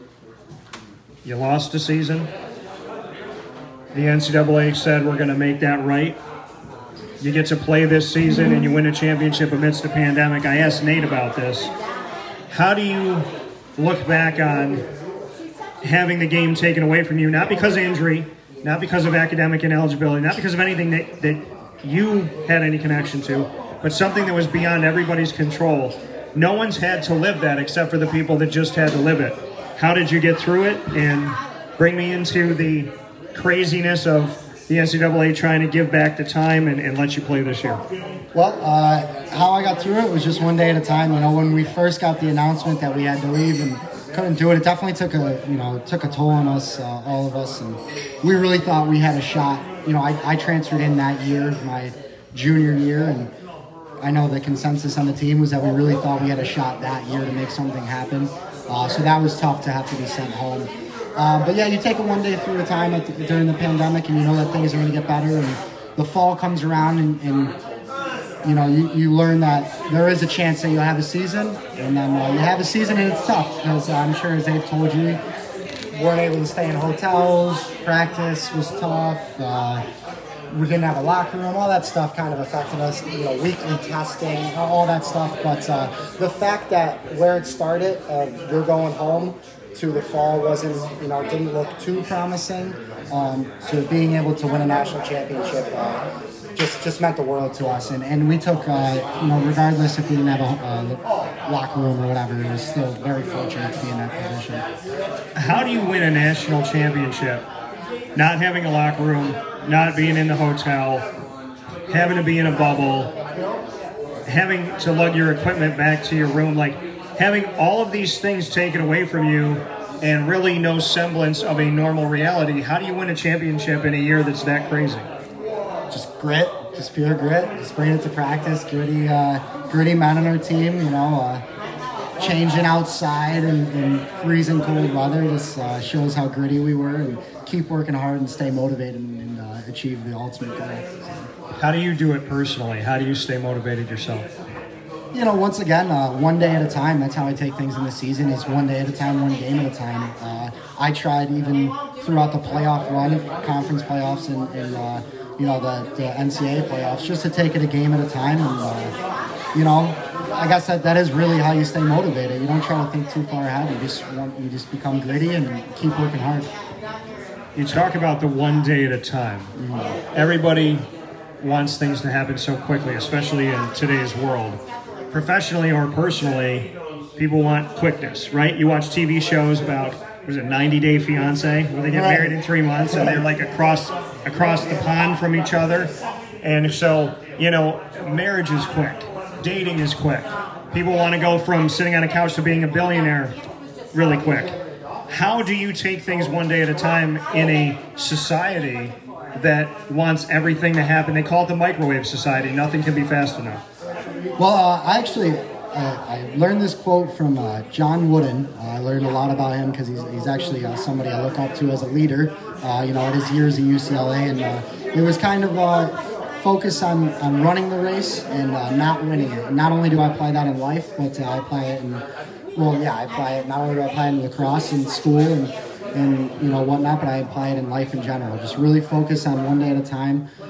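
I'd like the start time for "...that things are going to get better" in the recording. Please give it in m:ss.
1:04.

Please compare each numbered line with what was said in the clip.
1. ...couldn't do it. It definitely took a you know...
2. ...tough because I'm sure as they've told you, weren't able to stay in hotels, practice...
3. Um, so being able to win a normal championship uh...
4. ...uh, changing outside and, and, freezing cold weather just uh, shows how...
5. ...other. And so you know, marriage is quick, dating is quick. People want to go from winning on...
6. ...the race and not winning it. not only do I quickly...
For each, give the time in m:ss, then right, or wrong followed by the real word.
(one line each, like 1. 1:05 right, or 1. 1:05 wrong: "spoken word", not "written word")
1. 0:44 right
2. 1:13 right
3. 1:33 wrong: "national", not "normal"
4. 2:11 right
5. 3:05 wrong: "sitting", not "winning"
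6. 3:37 wrong: "apply", not "quickly".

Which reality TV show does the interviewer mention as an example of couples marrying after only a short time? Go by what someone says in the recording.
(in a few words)
90 Day Fiance.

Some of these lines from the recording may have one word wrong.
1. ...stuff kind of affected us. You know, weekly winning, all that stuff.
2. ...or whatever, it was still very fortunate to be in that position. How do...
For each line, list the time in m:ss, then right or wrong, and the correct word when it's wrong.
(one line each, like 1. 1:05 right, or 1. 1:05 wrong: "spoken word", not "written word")
1. 1:21 wrong: "testing", not "winning"
2. 1:41 right.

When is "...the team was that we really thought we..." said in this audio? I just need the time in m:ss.
0:55.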